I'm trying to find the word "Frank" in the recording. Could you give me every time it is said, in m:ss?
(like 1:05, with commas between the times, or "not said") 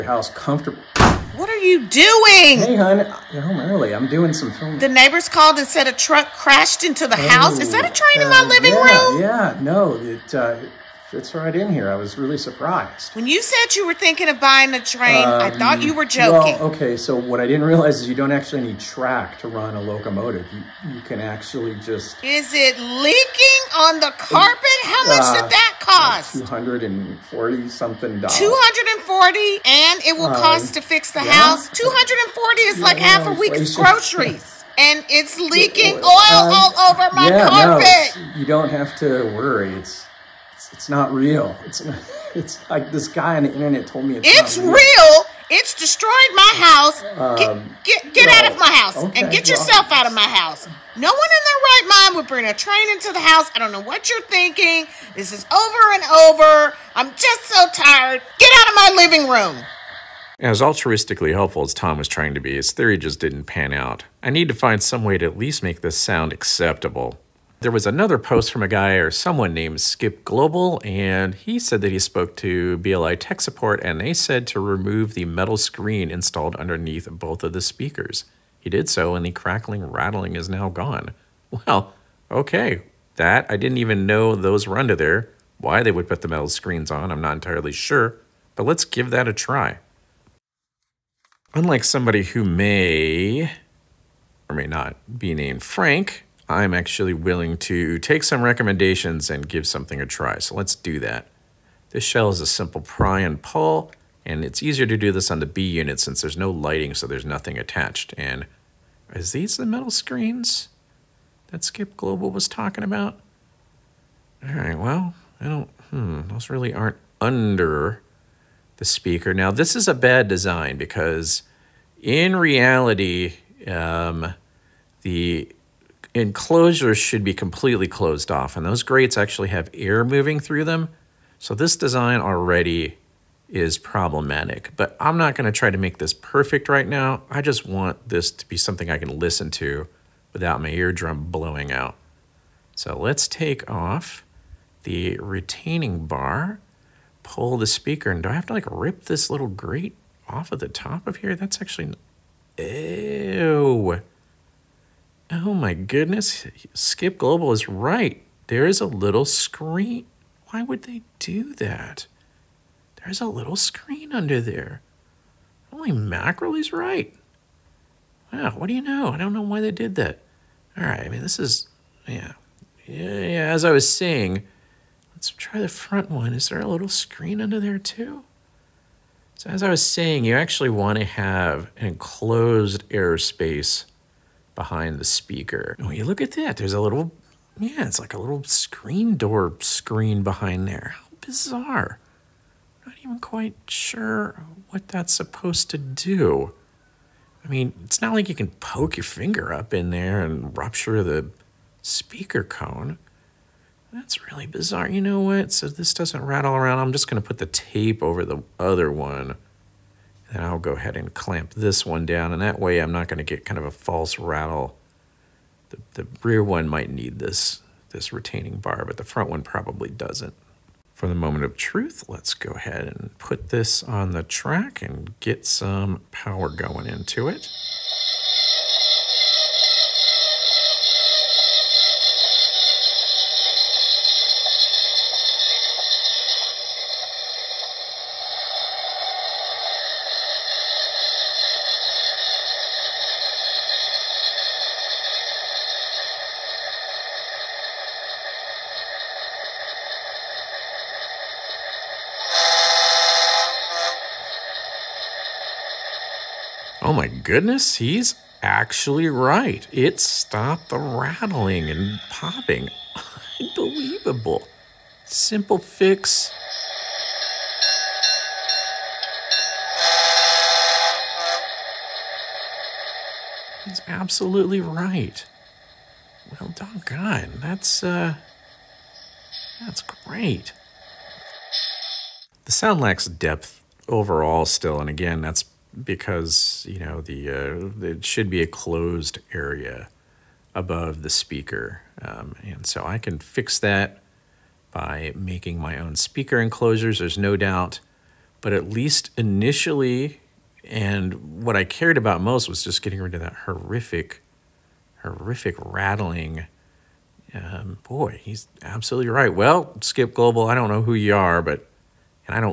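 1:35.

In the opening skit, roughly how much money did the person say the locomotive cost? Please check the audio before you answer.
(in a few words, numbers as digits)
240 something dollars.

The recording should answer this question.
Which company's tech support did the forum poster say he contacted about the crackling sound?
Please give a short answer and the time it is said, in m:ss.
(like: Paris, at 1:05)
BLI, at 1:12.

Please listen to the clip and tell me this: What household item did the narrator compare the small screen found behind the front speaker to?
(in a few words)
screen door screen.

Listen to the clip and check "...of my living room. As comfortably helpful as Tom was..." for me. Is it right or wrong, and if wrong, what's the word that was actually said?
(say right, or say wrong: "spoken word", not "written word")
wrong: "altruistically", not "comfortably".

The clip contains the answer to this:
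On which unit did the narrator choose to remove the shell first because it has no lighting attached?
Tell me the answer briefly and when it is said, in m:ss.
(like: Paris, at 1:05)
B unit, at 1:45.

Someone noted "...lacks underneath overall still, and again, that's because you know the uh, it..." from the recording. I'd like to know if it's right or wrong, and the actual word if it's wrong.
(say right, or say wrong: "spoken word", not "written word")
wrong: "depth", not "underneath".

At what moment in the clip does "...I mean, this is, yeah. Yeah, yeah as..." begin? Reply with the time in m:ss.
2:51.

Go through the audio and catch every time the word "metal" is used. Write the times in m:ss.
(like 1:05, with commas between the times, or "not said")
1:15, 1:26, 1:49.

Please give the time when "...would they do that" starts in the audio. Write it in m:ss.
2:40.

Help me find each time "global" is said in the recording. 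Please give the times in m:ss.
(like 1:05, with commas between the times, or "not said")
1:10, 1:51, 2:37, 5:10.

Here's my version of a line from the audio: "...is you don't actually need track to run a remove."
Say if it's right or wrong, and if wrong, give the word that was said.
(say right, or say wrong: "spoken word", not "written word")
wrong: "locomotive", not "remove".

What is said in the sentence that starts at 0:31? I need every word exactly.
240 is yeah, like half a week's groceries.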